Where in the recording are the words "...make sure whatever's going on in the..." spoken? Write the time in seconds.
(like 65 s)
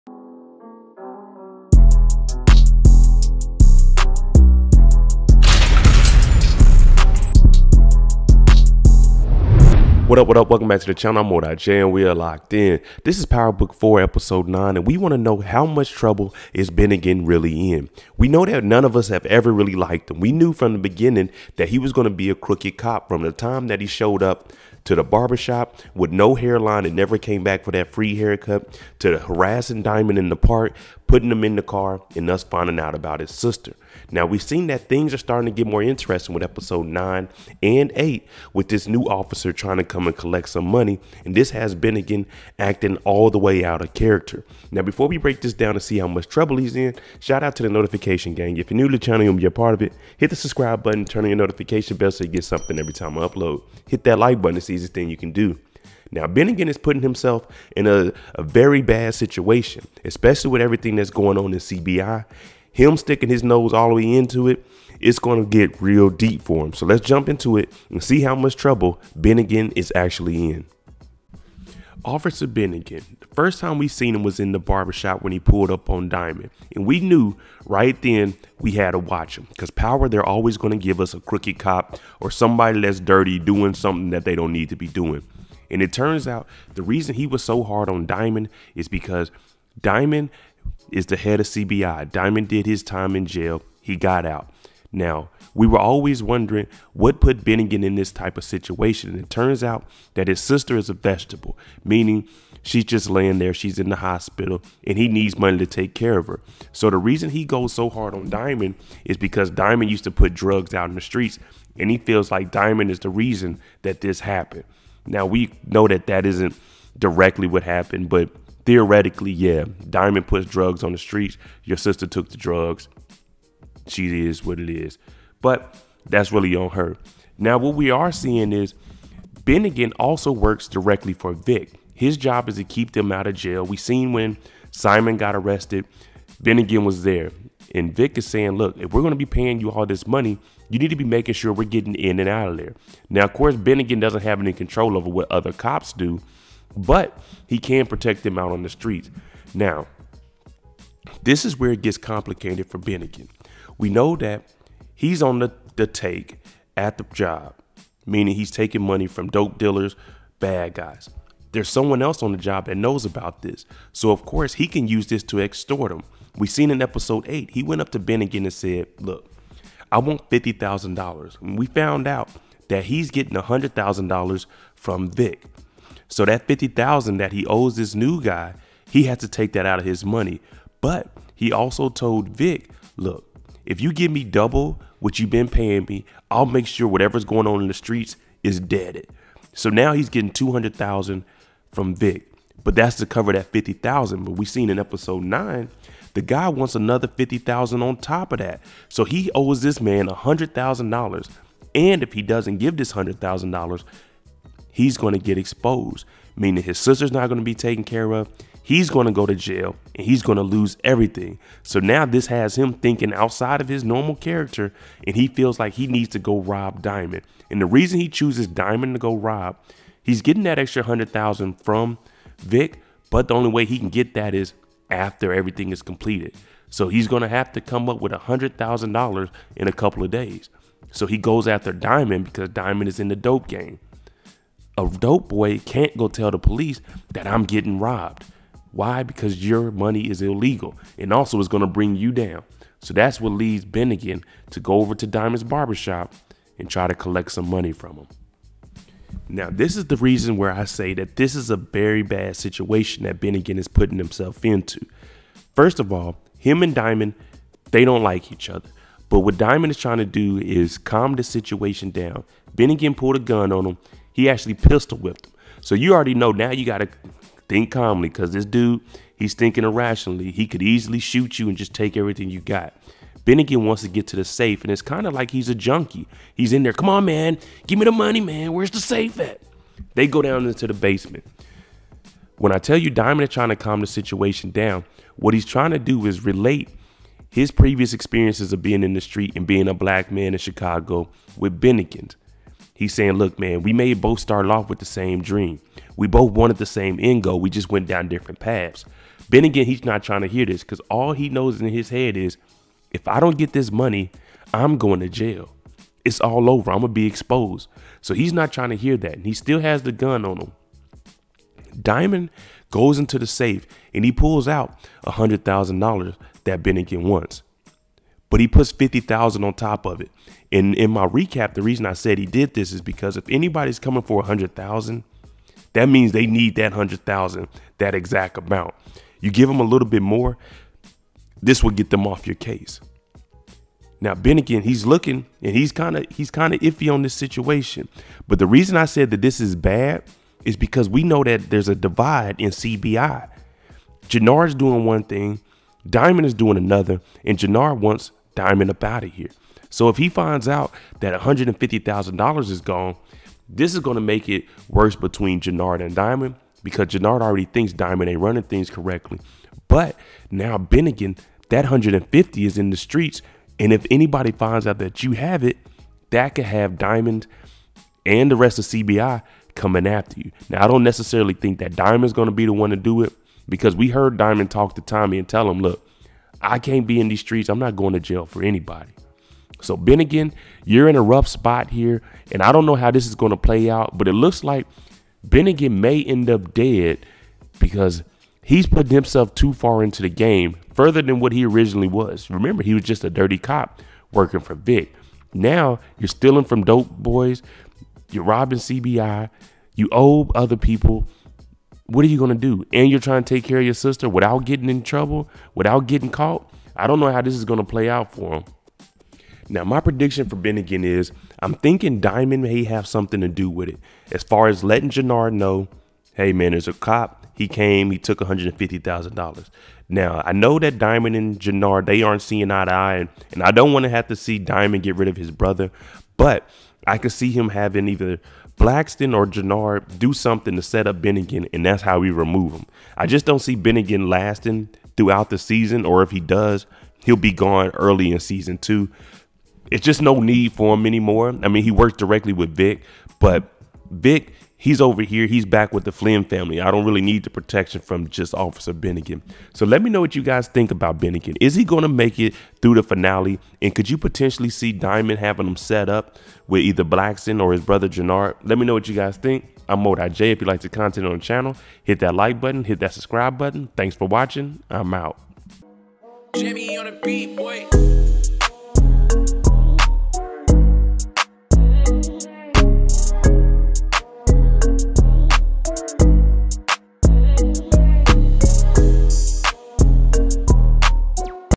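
186 s.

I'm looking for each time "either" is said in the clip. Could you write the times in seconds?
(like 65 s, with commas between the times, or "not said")
427 s, 456 s.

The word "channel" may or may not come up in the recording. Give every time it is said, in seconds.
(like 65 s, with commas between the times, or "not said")
10 s, 48 s, 461 s.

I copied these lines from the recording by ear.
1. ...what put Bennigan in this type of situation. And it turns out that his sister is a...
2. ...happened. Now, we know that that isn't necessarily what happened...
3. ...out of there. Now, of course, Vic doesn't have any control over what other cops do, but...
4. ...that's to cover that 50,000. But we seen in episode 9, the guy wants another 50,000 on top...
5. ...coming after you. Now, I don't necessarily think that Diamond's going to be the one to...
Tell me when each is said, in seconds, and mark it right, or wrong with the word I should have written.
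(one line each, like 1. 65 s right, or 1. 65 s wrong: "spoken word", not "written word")
1. 96 s right
2. 114 s wrong: "directly", not "necessarily"
3. 142 s wrong: "Bennigan", not "Vic"
4. 192 s right
5. 369 s right.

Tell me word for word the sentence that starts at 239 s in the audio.
Because your money is illegal and also it's going to bring you down.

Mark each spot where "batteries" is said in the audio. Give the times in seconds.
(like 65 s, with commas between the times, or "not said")
not said.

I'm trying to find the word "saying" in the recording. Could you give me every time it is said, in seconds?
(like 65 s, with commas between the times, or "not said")
138 s, 292 s.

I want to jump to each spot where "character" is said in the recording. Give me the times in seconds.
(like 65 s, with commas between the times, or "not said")
43 s, 214 s.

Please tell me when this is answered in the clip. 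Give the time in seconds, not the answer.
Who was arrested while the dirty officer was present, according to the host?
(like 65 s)
134 s.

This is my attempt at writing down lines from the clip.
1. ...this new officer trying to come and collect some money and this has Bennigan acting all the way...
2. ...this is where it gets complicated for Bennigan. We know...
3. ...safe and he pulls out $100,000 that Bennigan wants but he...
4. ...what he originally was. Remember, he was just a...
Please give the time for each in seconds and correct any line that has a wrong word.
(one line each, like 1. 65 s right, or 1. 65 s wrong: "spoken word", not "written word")
1. 38 s right
2. 151 s right
3. 313 s right
4. 391 s right.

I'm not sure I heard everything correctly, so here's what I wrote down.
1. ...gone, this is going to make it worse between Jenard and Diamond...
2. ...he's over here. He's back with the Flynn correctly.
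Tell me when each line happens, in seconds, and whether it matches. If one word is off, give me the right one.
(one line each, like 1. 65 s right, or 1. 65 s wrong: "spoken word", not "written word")
1. 352 s right
2. 444 s wrong: "family", not "correctly".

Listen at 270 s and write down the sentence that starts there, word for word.
He could easily shoot you and just take everything you got.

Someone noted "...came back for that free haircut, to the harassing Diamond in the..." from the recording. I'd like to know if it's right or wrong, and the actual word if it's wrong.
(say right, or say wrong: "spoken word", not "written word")
right.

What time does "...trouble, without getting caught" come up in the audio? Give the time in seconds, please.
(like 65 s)
404 s.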